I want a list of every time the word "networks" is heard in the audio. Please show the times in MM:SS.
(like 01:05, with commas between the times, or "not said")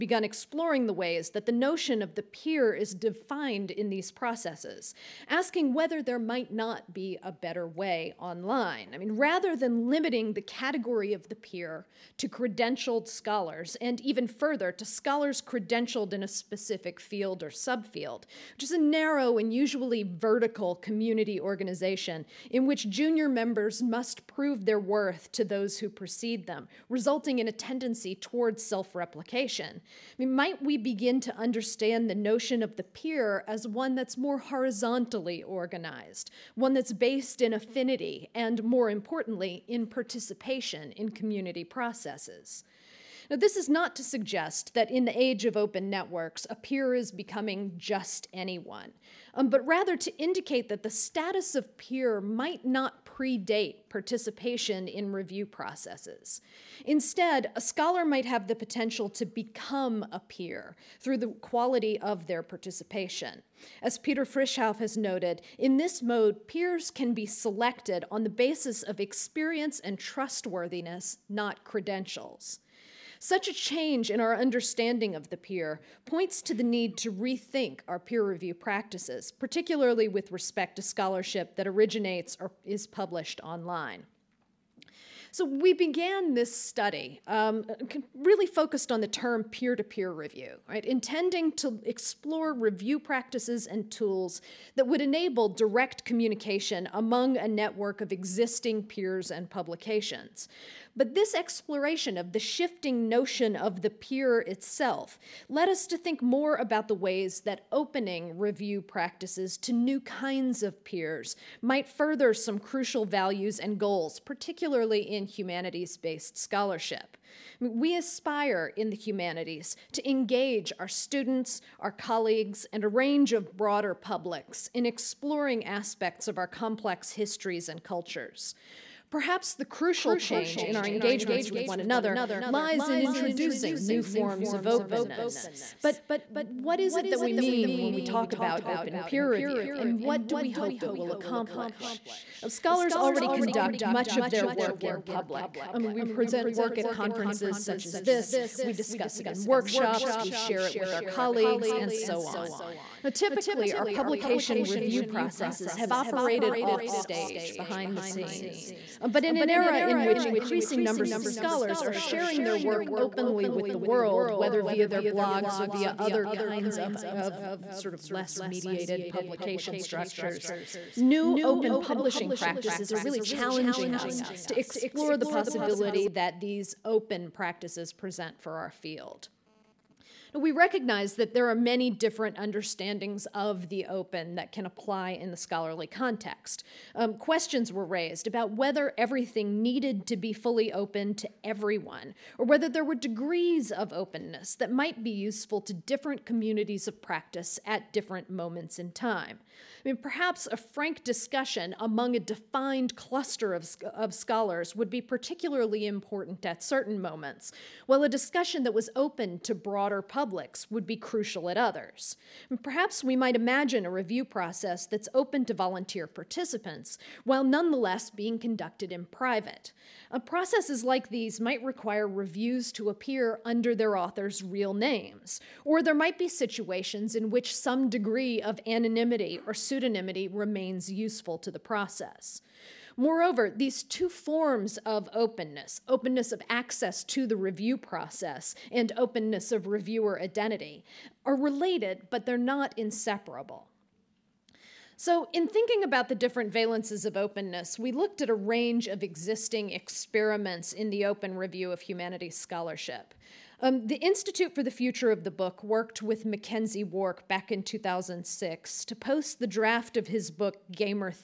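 00:45, 01:37.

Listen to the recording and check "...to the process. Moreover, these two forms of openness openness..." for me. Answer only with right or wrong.
right.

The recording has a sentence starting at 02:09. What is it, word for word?
Perhaps the crucial change in our engagements with one another lies in introducing new forms of openness.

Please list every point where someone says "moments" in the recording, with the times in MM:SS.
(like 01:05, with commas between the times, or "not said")
03:18, 03:26.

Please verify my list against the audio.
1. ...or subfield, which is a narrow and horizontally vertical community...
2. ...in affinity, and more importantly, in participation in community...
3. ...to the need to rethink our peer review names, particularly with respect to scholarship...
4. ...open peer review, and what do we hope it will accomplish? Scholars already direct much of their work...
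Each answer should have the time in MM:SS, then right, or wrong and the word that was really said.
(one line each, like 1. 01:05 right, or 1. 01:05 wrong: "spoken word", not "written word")
1. 00:17 wrong: "usually", not "horizontally"
2. 00:37 right
3. 01:16 wrong: "practices", not "names"
4. 02:18 wrong: "conduct", not "direct".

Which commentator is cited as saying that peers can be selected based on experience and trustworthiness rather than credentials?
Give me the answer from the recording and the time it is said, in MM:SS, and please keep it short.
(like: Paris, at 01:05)
Peter Frishauf, at 01:03.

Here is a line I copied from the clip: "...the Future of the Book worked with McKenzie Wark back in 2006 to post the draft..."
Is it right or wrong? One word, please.
right.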